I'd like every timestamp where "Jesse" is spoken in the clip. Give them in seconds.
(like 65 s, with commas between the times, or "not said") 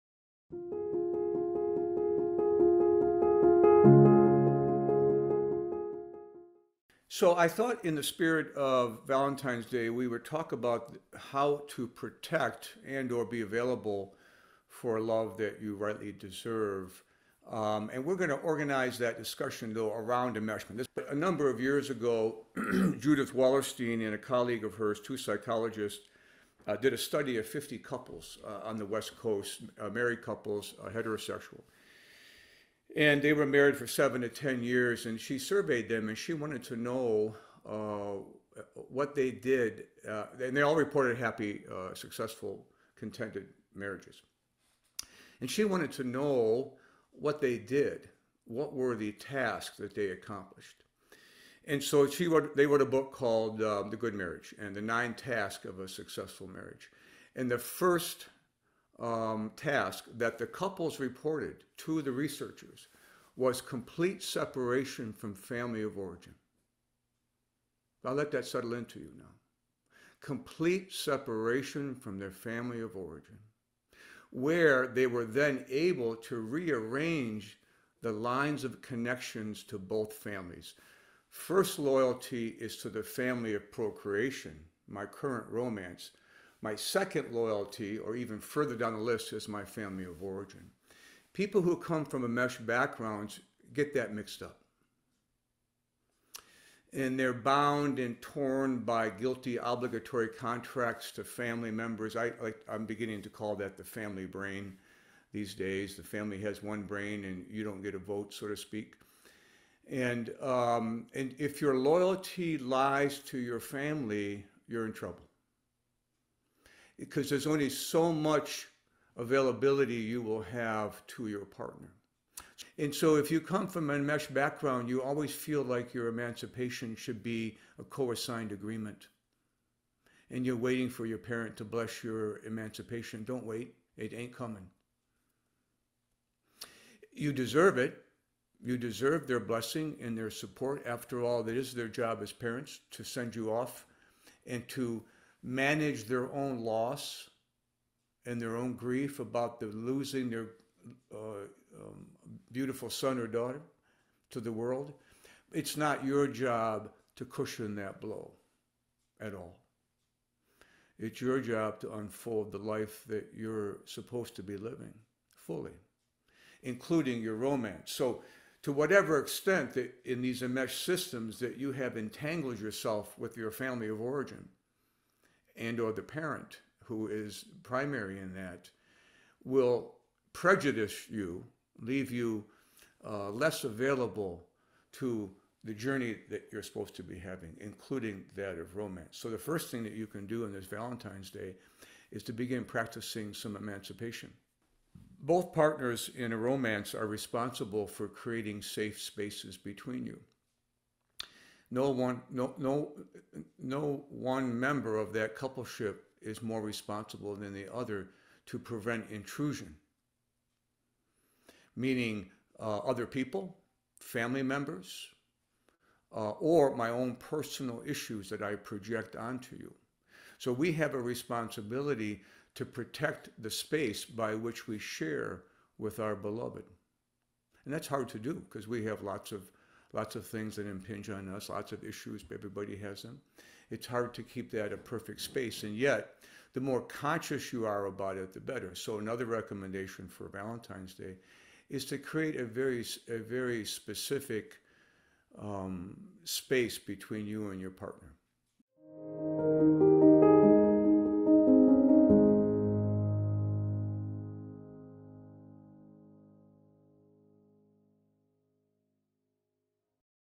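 not said.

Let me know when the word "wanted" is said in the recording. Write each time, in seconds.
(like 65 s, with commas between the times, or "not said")
36 s, 45 s.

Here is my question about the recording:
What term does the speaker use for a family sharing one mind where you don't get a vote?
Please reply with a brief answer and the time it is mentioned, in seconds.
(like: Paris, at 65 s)
the family brain, at 103 s.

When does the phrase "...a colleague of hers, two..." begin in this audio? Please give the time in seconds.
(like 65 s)
24 s.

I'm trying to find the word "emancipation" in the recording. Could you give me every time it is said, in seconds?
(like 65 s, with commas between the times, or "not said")
126 s, 132 s, 193 s.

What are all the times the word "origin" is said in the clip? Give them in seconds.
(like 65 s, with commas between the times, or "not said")
65 s, 72 s, 90 s, 173 s.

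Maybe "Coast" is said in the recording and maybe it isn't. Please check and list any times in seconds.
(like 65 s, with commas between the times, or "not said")
29 s.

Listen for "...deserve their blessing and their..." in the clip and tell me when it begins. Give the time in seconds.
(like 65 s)
138 s.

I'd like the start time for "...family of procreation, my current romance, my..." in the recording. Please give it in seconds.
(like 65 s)
83 s.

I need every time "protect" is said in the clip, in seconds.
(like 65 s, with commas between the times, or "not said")
11 s, 222 s.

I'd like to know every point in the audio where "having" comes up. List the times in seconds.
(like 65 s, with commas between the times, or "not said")
187 s.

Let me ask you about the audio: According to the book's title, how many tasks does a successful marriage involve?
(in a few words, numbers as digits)
9.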